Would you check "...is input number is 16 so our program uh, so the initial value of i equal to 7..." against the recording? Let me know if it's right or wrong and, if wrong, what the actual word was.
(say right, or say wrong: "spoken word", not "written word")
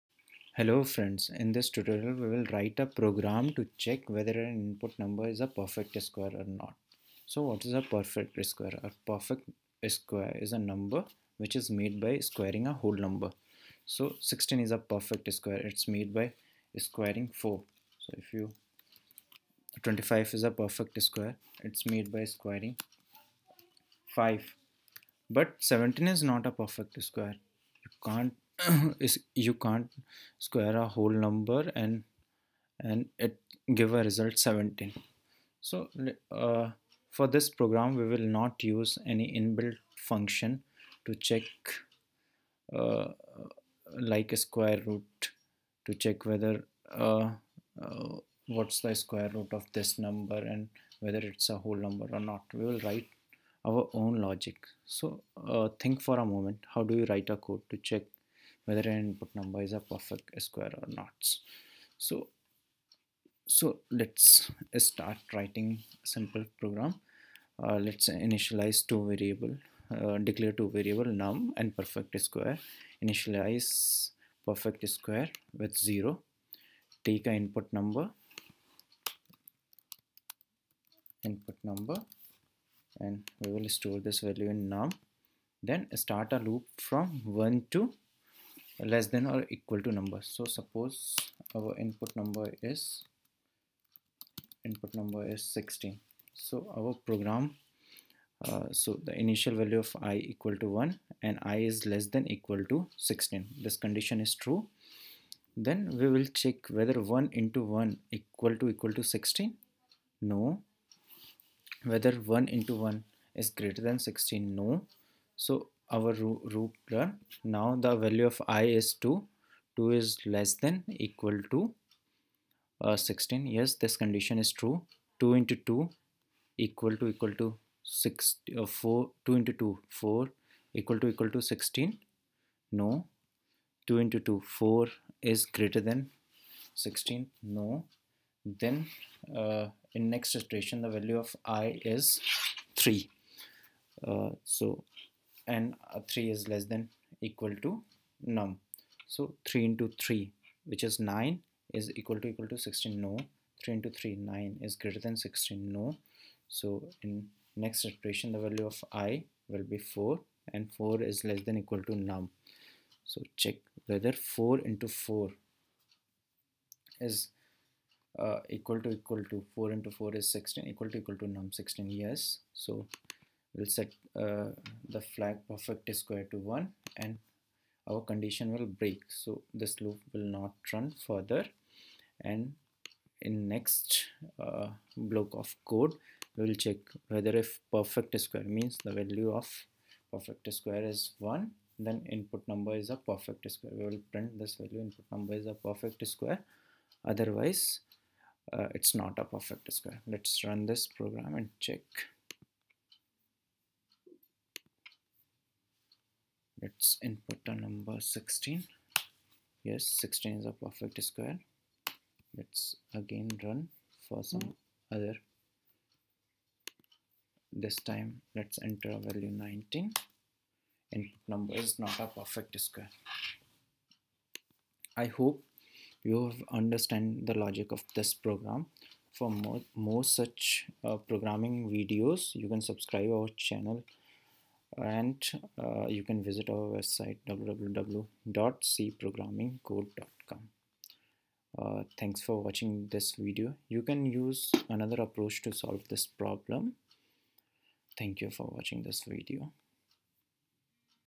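wrong: "1", not "7".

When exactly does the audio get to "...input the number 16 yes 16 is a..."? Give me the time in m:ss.
3:27.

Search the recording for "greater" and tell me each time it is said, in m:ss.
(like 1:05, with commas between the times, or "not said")
1:53, 2:15, 2:34.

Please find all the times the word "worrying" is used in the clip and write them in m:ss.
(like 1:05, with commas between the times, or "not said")
not said.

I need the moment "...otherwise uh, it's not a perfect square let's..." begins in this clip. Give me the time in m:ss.
3:17.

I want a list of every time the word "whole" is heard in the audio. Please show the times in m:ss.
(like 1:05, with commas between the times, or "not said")
0:12, 0:30, 0:51.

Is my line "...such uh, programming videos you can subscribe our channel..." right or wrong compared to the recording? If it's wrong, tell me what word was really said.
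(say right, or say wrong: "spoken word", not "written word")
right.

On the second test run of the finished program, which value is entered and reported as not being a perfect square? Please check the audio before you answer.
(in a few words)
19.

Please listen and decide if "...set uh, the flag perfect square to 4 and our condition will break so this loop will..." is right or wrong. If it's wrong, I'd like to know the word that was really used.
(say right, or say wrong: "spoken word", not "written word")
wrong: "1", not "4".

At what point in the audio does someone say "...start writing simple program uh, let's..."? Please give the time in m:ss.
1:04.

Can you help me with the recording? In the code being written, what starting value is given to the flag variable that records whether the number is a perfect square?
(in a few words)
0.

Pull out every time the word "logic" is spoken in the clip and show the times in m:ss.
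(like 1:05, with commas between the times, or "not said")
0:54, 3:47.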